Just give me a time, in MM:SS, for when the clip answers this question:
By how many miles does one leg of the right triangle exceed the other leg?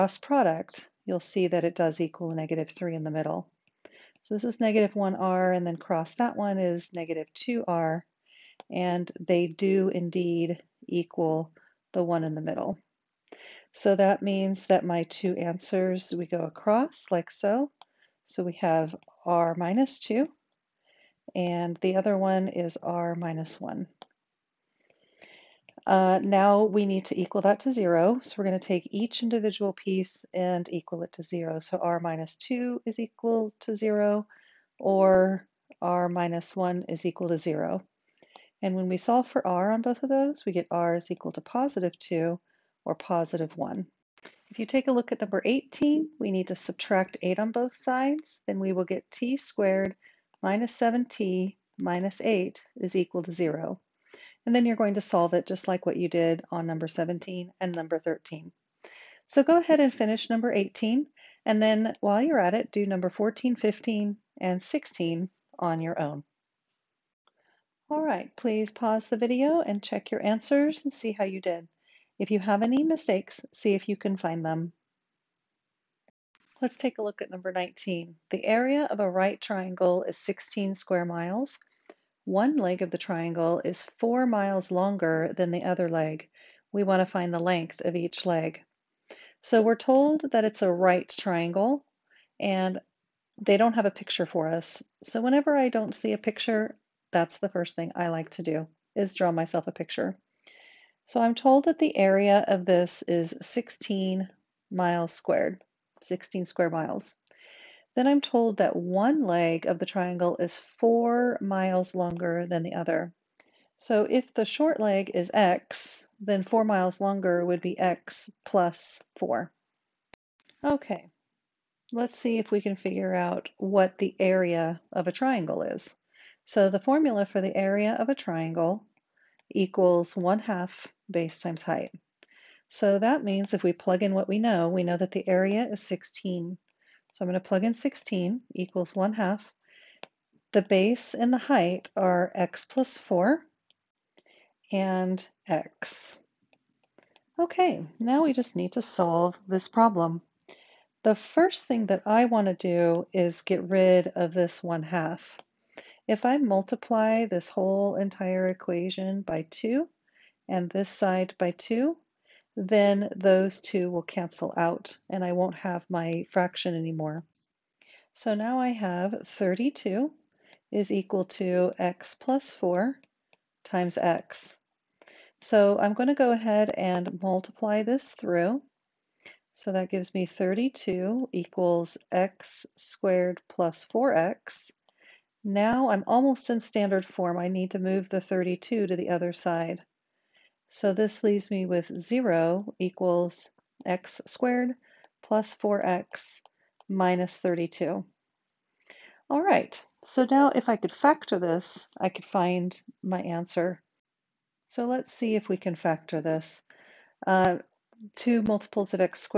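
01:23.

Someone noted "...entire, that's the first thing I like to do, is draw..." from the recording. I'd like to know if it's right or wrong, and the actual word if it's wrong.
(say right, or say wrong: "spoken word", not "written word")
wrong: "picture", not "entire".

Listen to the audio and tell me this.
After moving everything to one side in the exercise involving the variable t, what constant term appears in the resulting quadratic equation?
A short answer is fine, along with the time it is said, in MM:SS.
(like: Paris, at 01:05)
-8, at 00:51.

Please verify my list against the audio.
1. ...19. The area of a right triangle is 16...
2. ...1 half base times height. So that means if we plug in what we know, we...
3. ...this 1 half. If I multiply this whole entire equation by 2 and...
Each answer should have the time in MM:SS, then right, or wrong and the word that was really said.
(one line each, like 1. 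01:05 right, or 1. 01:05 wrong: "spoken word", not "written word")
1. 01:17 right
2. 02:10 right
3. 02:34 right.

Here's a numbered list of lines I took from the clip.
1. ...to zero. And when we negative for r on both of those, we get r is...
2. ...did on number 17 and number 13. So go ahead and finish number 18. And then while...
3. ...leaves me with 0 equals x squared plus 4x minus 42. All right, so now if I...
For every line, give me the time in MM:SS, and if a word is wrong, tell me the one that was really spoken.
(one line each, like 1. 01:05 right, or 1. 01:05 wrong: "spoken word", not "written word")
1. 00:37 wrong: "solve", not "negative"
2. 00:56 right
3. 03:11 wrong: "32", not "42".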